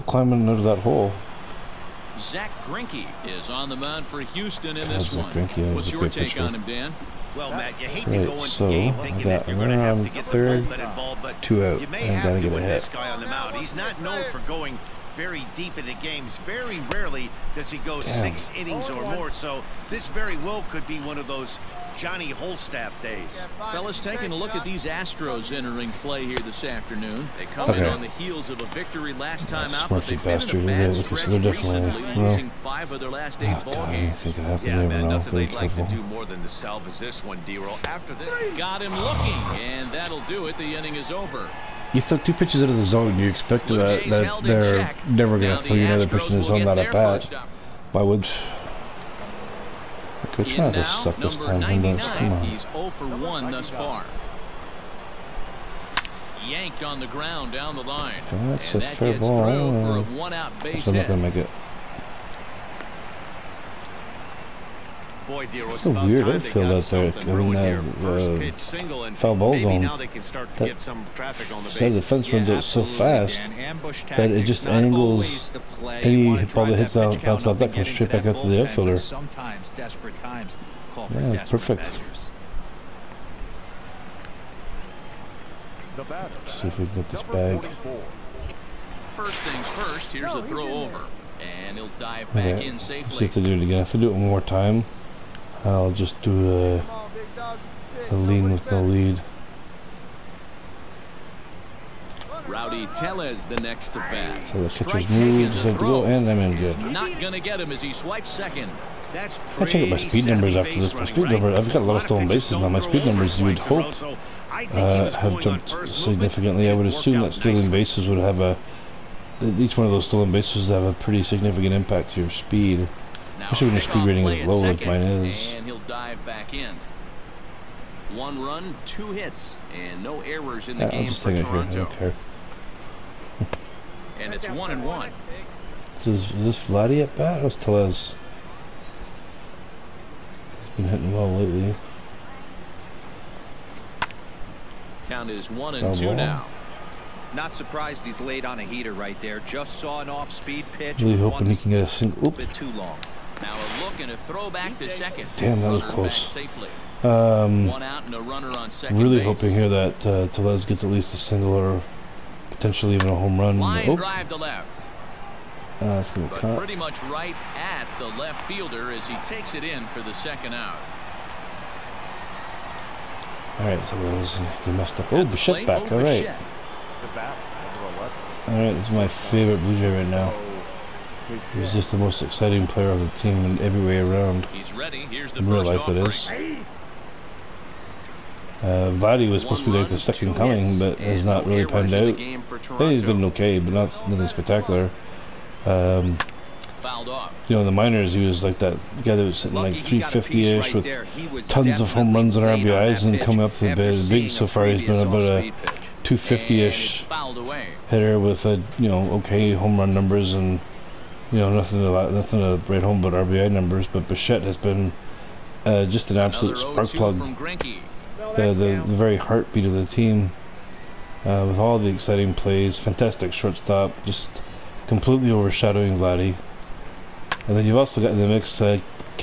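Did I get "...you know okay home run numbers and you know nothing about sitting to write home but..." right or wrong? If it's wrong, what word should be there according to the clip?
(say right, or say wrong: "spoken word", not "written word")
wrong: "nothing", not "sitting".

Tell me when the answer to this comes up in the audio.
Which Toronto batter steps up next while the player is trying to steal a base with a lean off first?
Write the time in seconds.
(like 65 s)
102 s.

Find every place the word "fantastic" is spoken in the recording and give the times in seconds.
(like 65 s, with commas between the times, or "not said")
222 s.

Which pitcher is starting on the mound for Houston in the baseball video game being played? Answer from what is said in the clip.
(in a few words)
Zack Greinke.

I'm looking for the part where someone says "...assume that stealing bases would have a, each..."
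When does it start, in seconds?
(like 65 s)
116 s.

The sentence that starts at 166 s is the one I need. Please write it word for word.
pretty much right at the left fielder as he takes it in for the second out.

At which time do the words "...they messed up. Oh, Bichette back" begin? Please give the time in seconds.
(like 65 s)
174 s.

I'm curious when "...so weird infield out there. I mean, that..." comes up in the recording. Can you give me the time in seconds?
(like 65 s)
65 s.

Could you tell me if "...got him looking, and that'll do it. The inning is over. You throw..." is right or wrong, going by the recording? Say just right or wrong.
right.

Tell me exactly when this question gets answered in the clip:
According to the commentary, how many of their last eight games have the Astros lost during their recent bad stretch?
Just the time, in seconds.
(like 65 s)
32 s.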